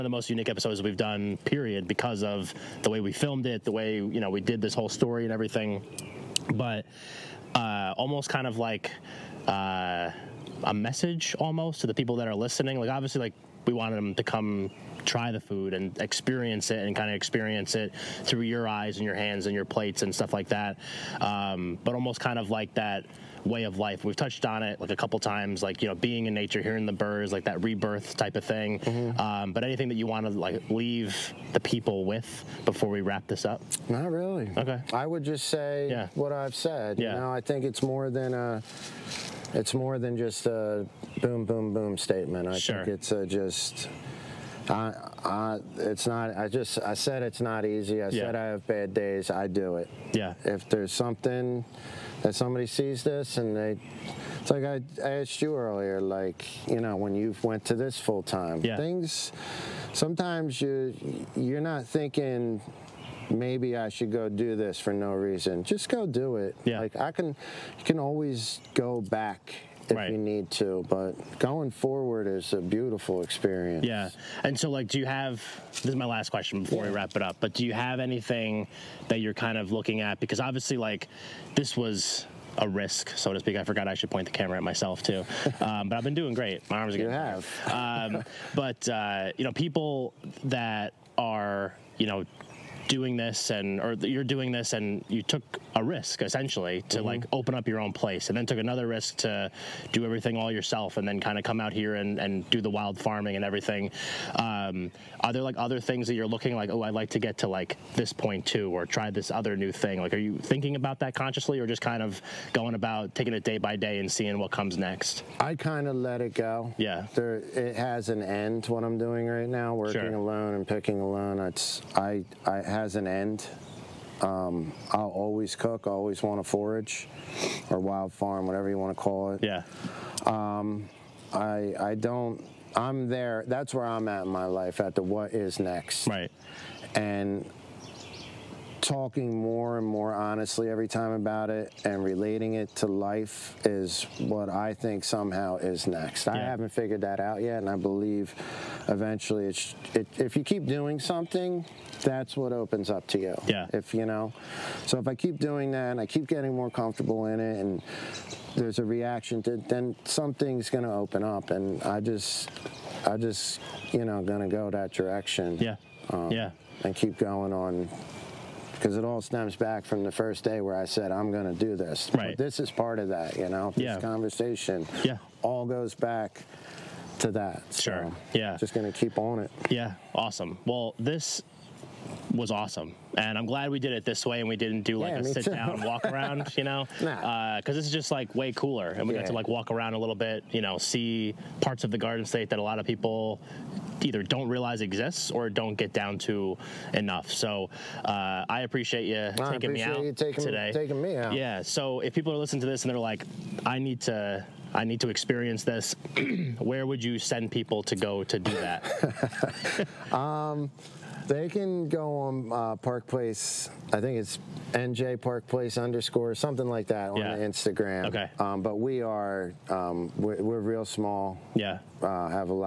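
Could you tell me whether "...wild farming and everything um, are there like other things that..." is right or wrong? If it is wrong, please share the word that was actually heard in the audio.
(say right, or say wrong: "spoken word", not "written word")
right.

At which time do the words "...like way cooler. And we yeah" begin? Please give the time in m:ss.
3:08.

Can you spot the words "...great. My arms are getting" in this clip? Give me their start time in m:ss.
1:26.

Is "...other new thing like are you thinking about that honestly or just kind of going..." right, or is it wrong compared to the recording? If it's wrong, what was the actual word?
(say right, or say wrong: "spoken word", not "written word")
wrong: "consciously", not "honestly".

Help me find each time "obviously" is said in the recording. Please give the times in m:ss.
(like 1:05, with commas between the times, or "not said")
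0:12, 1:20.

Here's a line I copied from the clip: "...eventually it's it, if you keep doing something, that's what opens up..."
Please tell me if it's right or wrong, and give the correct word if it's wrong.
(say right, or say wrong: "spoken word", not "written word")
right.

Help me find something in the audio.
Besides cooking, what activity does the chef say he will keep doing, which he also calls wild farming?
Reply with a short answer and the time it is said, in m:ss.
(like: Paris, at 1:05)
forage, at 2:06.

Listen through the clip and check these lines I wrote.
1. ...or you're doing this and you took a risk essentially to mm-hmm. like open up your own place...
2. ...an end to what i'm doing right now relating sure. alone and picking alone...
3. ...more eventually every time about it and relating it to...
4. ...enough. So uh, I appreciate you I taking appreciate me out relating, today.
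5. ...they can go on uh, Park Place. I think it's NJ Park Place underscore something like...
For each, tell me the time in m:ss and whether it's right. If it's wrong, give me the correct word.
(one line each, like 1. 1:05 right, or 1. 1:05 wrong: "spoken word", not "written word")
1. 1:33 right
2. 1:58 wrong: "working", not "relating"
3. 2:19 wrong: "honestly", not "eventually"
4. 3:16 wrong: "taking", not "relating"
5. 3:31 right.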